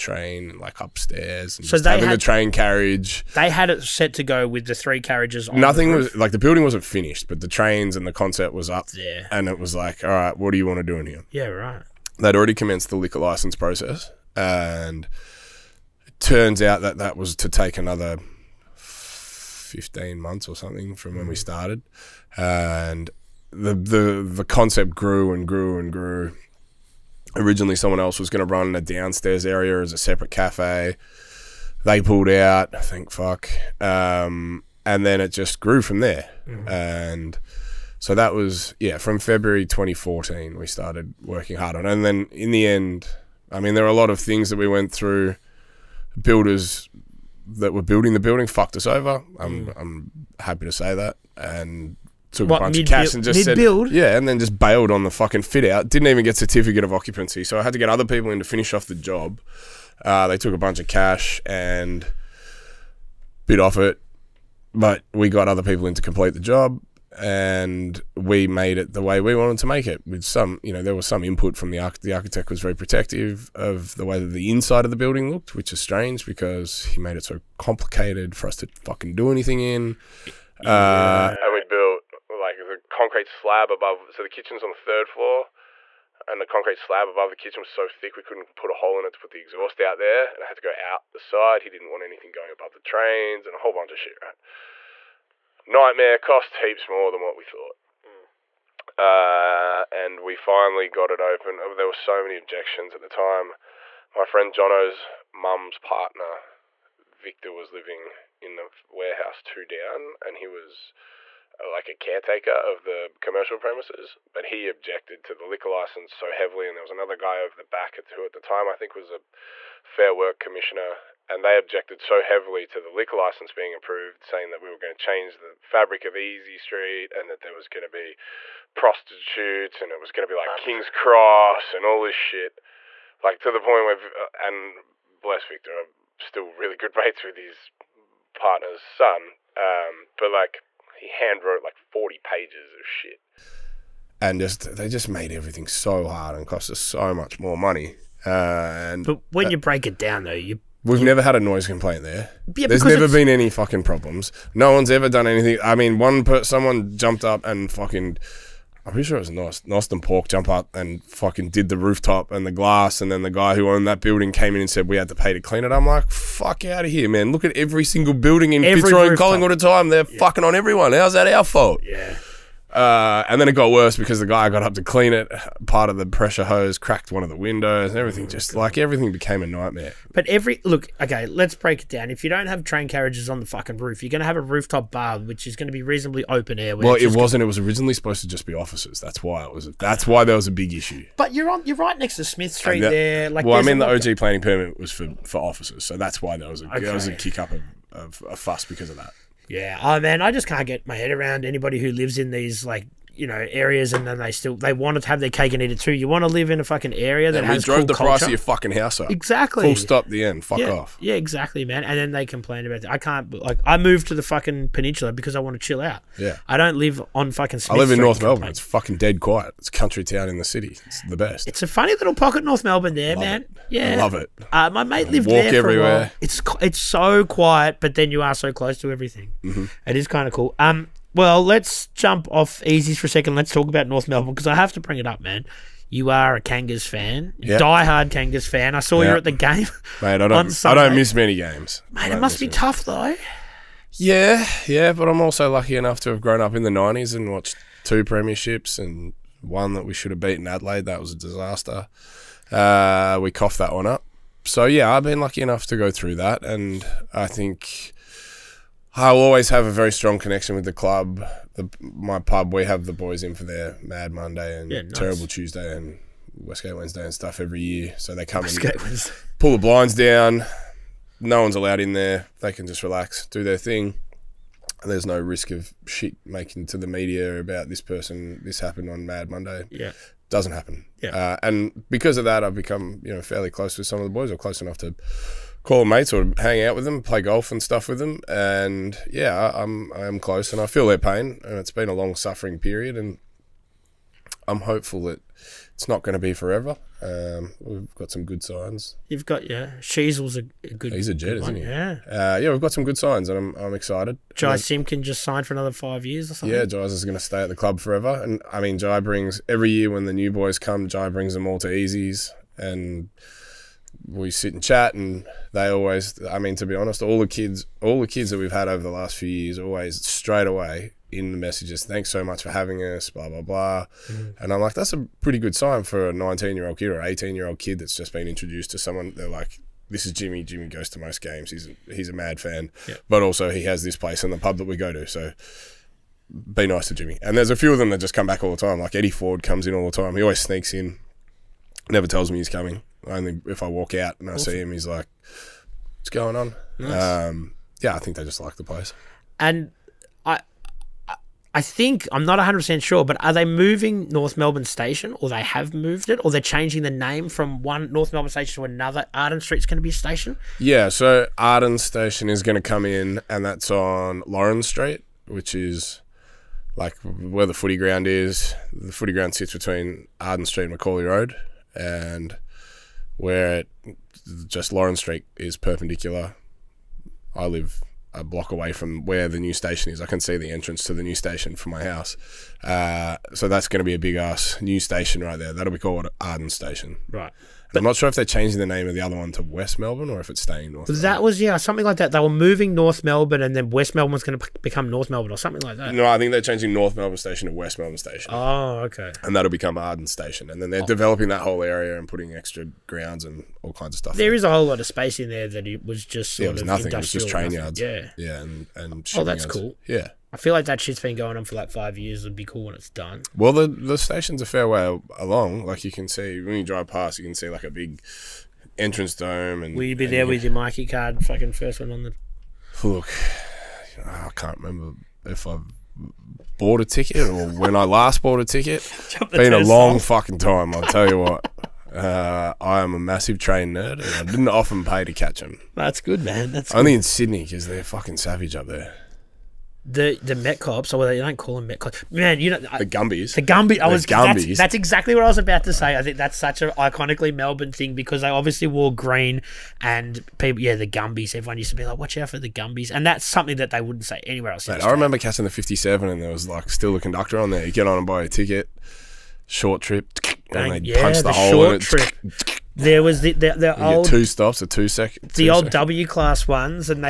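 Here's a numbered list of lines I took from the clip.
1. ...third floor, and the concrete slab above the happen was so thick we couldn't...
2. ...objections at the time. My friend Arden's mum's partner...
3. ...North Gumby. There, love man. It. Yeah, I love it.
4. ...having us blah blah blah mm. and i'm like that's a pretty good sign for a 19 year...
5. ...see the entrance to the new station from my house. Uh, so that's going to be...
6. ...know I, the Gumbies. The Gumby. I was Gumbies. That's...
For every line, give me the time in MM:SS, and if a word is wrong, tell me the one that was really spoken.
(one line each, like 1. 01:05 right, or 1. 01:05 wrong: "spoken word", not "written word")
1. 01:24 wrong: "kitchen", not "happen"
2. 01:42 wrong: "Jono", not "Arden"
3. 03:42 wrong: "Melbourne", not "Gumby"
4. 05:22 right
5. 06:20 right
6. 07:22 right.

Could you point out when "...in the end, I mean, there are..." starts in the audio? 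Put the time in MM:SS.
00:42.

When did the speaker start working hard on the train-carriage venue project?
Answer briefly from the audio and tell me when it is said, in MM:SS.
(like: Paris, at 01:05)
February 2014, at 00:39.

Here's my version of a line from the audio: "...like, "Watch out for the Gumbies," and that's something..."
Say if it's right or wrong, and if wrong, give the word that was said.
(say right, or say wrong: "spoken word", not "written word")
right.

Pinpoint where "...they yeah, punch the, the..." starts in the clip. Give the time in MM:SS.
07:40.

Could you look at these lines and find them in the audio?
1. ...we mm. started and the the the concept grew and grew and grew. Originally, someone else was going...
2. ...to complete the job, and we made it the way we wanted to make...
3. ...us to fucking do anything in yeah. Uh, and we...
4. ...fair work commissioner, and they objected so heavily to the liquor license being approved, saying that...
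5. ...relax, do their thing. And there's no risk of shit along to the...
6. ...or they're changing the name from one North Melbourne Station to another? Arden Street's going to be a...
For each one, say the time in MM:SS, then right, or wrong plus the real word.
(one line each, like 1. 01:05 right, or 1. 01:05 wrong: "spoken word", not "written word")
1. 00:21 right
2. 01:05 right
3. 01:18 right
4. 01:59 right
5. 04:32 wrong: "making", not "along"
6. 05:56 right.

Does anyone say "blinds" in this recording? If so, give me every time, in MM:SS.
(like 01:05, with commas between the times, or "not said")
04:29.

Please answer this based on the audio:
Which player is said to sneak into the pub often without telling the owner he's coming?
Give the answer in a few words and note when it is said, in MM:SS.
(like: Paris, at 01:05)
Eddie Ford, at 05:38.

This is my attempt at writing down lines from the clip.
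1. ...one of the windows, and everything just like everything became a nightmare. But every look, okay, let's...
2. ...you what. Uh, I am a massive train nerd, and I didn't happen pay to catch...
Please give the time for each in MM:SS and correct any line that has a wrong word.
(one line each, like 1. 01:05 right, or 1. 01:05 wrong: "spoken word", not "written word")
1. 02:57 right
2. 07:11 wrong: "often", not "happen".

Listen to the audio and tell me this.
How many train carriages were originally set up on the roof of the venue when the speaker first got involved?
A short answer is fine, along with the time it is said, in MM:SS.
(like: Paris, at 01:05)
3, at 00:04.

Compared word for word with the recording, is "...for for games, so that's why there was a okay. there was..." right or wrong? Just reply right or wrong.
wrong.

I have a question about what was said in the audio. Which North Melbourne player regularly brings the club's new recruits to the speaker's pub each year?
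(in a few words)
Jy Simpkin.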